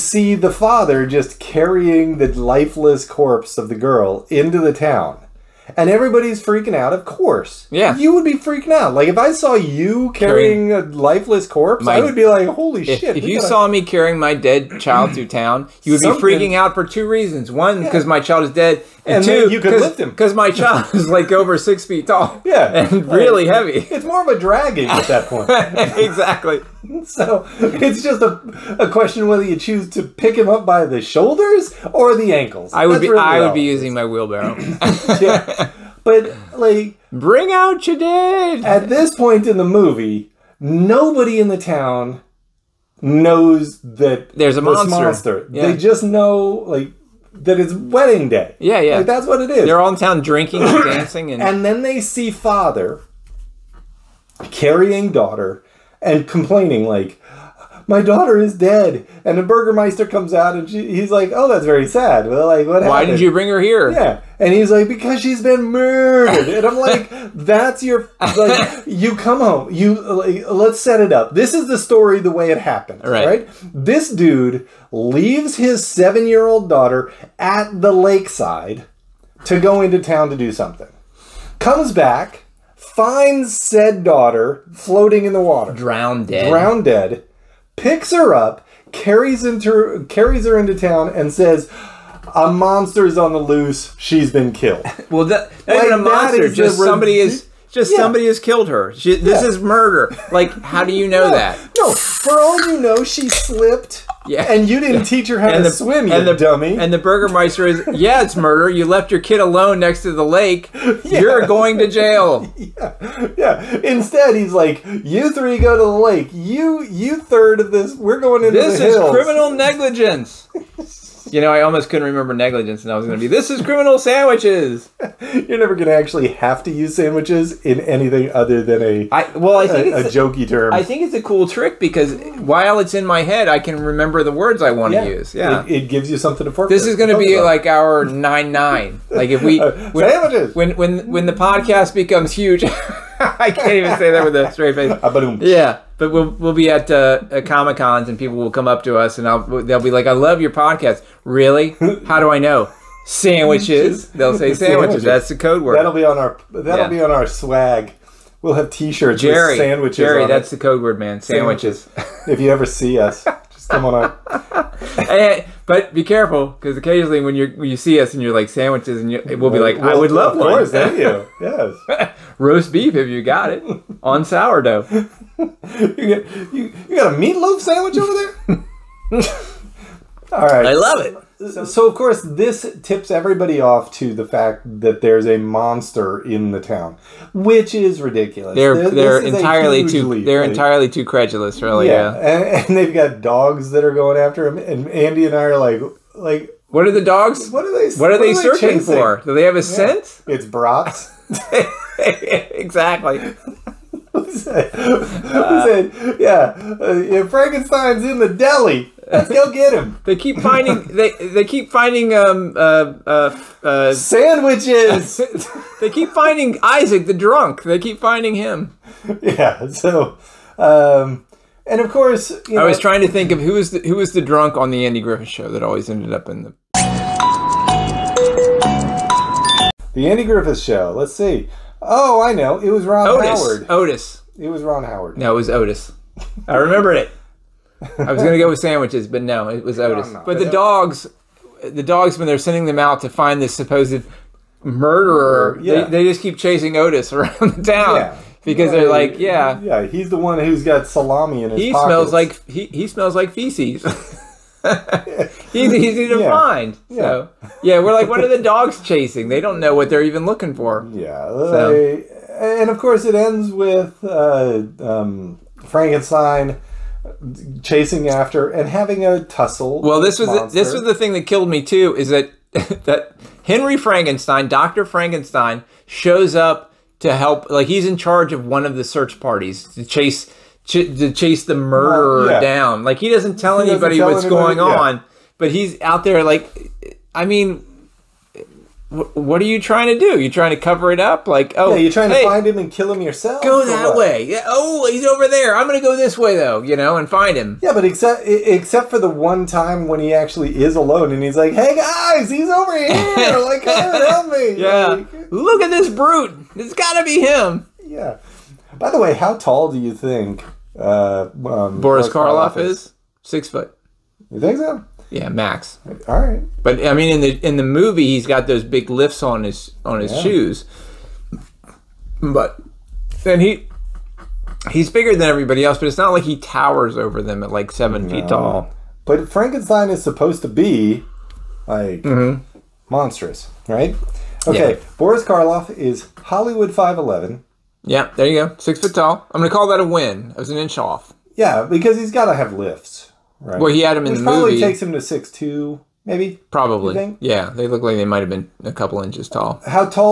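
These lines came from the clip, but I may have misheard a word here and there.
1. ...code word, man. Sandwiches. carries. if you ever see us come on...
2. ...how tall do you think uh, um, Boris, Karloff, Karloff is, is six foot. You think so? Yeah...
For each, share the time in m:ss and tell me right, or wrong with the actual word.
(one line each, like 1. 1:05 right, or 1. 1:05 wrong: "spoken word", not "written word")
1. 2:40 wrong: "sandwiches", not "carries"
2. 5:09 right.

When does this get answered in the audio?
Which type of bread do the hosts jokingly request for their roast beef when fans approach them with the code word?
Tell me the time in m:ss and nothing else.
2:54.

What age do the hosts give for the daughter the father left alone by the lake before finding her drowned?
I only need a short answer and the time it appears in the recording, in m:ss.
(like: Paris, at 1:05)
7, at 1:15.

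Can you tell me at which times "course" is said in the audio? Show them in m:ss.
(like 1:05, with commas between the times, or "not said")
0:07, 2:50, 3:01, 3:41, 4:22.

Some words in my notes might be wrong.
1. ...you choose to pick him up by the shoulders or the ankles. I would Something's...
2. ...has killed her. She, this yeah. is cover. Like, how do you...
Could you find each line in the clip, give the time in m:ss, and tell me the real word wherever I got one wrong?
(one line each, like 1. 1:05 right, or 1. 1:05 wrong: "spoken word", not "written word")
1. 0:29 wrong: "That", not "Something"
2. 1:38 wrong: "murder", not "cover".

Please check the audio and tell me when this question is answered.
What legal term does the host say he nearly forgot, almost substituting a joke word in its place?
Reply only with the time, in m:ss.
1:59.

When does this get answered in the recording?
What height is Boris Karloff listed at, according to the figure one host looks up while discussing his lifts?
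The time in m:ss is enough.
5:36.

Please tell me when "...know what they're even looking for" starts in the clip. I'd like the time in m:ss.
4:19.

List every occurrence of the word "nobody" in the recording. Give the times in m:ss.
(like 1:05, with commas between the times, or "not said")
0:40.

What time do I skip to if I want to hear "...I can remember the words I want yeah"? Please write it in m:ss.
2:13.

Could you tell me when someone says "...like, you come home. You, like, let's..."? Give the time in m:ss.
1:08.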